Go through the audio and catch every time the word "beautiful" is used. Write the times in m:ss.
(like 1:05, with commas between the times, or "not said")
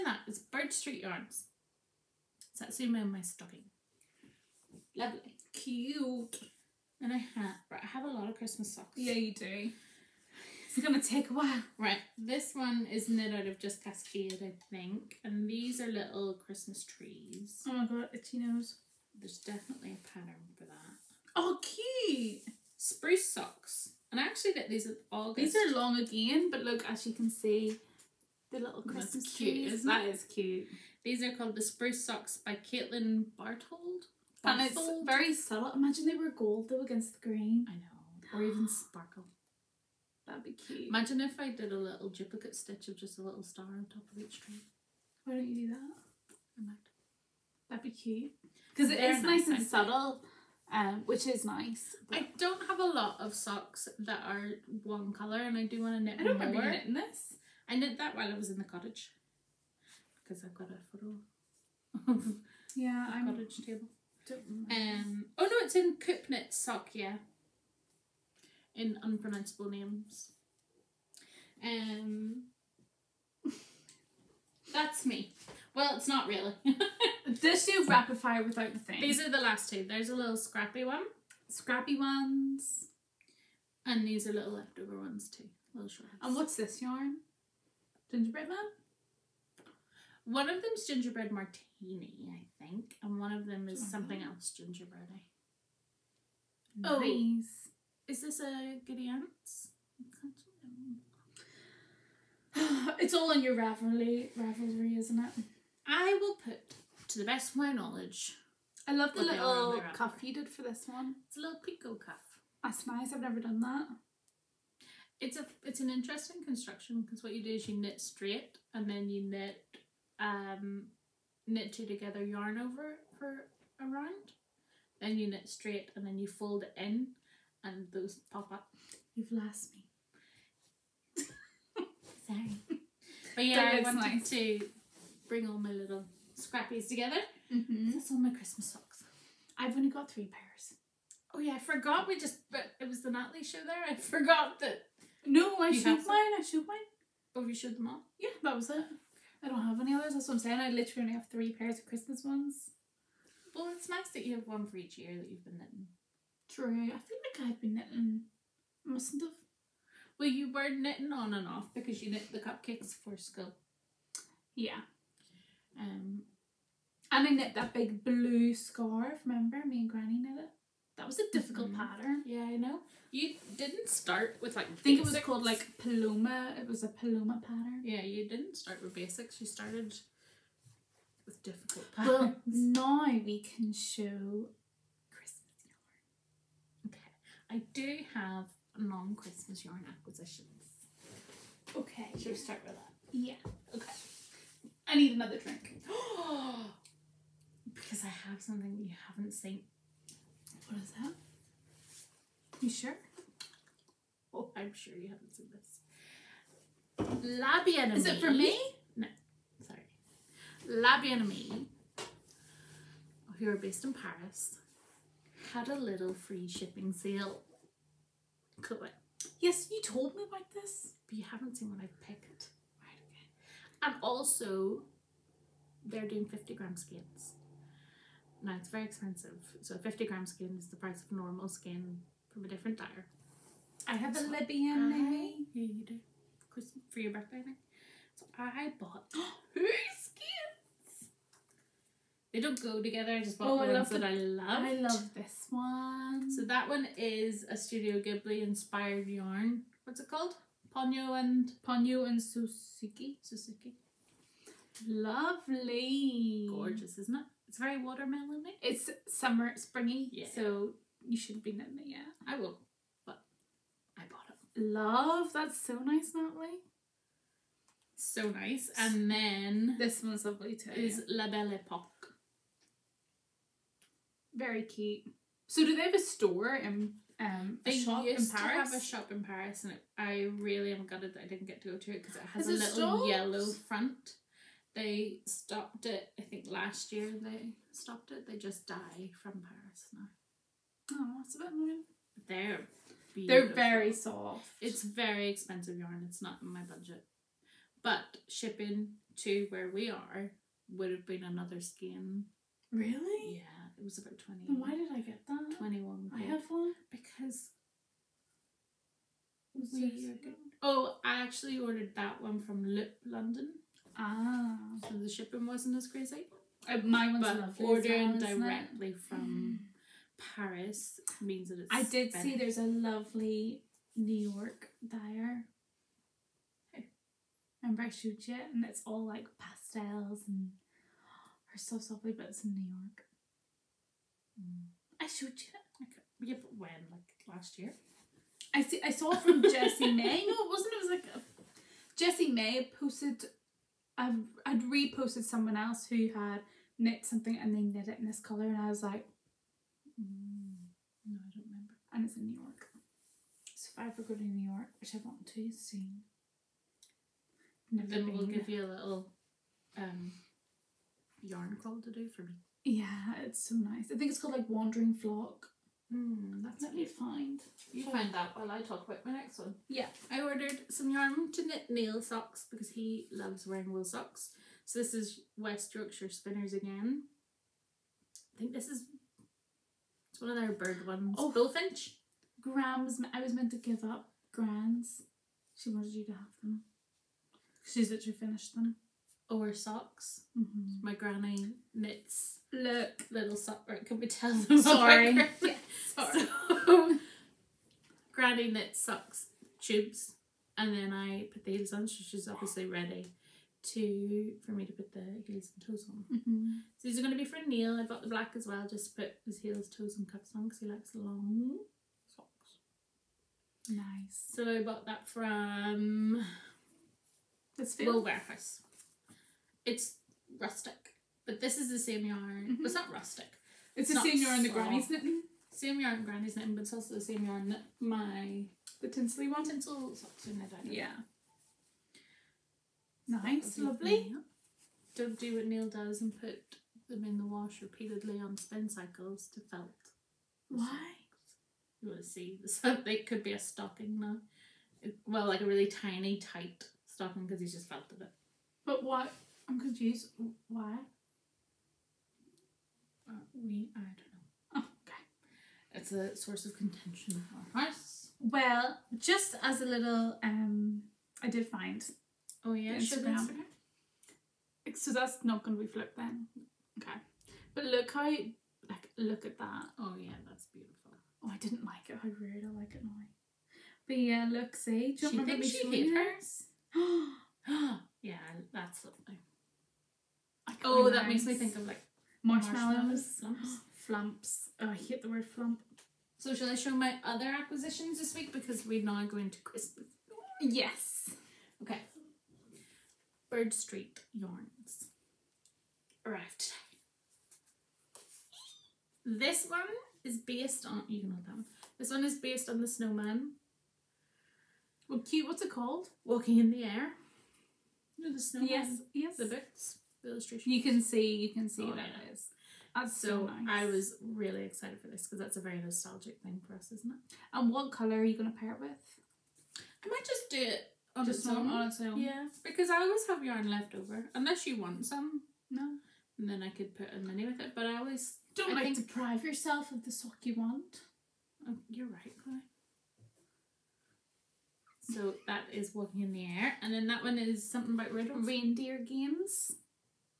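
4:53, 7:50.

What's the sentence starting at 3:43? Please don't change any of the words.
And also, they're doing 50 gram skeins.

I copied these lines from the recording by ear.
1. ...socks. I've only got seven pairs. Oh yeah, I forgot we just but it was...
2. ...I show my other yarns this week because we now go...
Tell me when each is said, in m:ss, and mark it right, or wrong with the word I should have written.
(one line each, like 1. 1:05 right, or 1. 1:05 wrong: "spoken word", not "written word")
1. 2:18 wrong: "three", not "seven"
2. 8:06 wrong: "acquisitions", not "yarns".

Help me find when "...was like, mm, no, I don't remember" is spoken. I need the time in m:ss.
5:48.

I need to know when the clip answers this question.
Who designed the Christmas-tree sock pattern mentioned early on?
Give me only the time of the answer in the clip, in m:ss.
0:32.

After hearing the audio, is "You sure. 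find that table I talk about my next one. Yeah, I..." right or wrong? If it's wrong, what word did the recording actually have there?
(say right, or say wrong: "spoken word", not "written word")
wrong: "while", not "table".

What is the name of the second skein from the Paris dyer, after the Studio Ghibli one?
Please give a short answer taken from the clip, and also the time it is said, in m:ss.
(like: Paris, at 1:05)
La Belle Epoque, at 4:31.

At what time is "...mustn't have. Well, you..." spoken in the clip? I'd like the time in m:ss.
2:38.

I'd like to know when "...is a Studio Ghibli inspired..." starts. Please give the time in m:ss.
4:06.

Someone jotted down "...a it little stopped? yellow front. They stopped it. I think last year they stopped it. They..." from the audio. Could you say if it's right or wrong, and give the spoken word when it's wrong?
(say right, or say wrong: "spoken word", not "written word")
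right.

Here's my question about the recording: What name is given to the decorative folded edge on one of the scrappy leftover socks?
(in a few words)
pico cuff.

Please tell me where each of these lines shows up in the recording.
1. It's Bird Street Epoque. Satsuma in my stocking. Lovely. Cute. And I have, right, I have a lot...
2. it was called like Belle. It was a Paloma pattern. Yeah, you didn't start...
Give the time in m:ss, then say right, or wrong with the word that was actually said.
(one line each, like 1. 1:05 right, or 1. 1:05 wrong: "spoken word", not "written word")
1. 0:00 wrong: "Yarns", not "Epoque"
2. 2:55 wrong: "Paloma", not "Belle".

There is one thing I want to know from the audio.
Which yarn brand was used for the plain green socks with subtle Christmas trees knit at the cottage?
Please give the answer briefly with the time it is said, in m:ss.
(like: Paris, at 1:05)
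CoopKnit, at 1:05.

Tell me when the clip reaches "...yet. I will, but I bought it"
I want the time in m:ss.
4:21.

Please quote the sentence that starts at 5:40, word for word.
It was like Jessie May posted.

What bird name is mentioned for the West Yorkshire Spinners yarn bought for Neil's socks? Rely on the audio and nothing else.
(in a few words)
bullfinch.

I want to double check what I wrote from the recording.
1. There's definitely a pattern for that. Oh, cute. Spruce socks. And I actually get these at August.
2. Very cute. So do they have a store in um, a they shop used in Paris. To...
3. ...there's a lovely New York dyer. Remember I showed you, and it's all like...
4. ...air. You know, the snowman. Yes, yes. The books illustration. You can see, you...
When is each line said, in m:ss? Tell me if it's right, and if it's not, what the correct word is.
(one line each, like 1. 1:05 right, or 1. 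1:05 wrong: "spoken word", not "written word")
1. 0:19 right
2. 4:34 right
3. 5:22 right
4. 8:26 right.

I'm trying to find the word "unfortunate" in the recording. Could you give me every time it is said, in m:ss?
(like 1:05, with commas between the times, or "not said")
not said.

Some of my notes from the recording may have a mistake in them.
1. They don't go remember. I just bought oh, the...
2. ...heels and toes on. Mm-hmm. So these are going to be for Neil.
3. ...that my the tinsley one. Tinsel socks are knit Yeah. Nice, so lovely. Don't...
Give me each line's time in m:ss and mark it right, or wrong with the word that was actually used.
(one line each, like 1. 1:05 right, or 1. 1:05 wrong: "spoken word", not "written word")
1. 4:02 wrong: "together", not "remember"
2. 6:45 right
3. 7:07 right.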